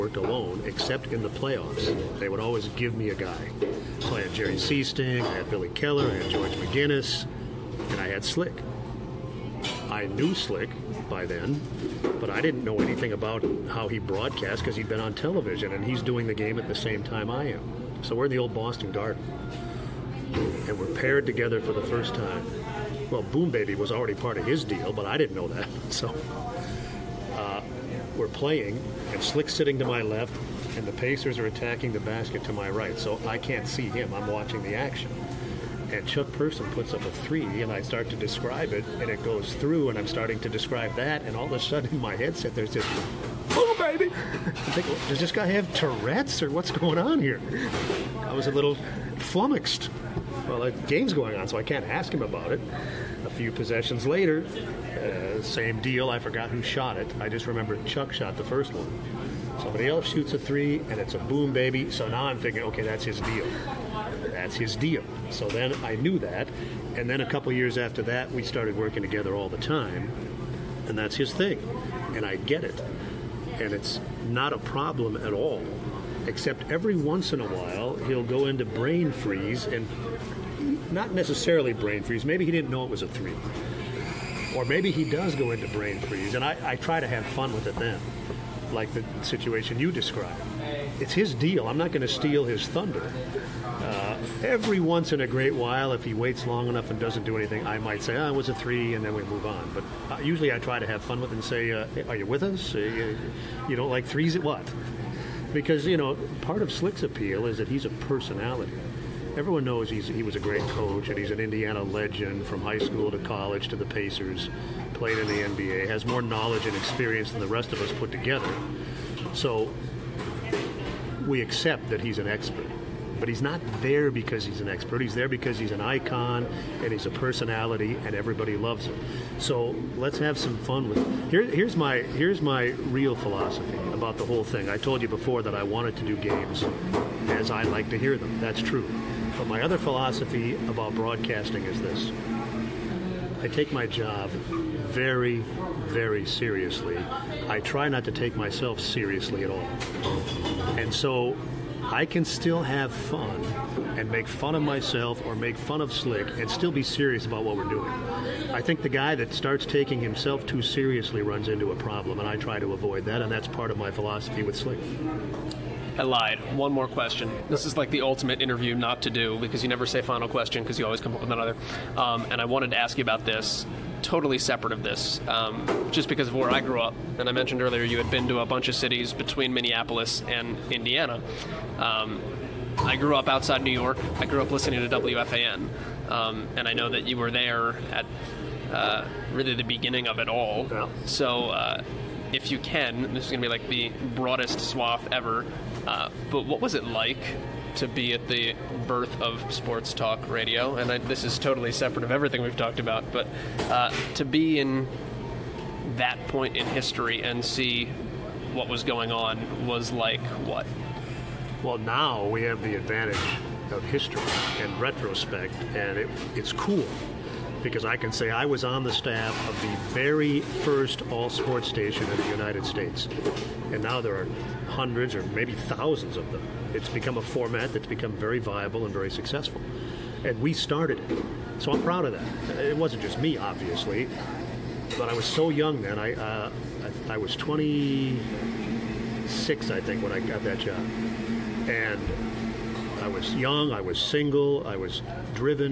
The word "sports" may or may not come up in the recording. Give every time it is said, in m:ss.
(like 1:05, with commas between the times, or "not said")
3:19, 3:41.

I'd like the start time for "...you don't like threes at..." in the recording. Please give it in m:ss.
1:43.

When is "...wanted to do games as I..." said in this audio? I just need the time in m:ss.
2:15.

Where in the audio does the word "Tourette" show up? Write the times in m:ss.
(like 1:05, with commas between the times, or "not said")
0:45.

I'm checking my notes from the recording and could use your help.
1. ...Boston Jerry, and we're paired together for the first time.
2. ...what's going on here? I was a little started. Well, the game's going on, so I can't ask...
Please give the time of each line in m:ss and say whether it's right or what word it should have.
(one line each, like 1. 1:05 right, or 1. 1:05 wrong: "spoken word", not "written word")
1. 0:18 wrong: "Garden", not "Jerry"
2. 0:46 wrong: "flummoxed", not "started".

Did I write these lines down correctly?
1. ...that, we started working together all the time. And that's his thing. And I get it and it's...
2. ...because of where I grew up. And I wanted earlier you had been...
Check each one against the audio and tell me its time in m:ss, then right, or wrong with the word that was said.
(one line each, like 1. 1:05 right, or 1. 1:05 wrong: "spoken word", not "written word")
1. 1:08 right
2. 2:56 wrong: "mentioned", not "wanted".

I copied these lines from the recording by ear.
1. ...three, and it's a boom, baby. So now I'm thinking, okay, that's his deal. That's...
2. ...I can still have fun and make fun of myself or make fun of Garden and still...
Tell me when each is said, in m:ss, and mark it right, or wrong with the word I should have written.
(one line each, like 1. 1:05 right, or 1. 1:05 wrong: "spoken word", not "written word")
1. 1:00 right
2. 2:31 wrong: "Slick", not "Garden".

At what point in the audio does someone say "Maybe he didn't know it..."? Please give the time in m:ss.
1:22.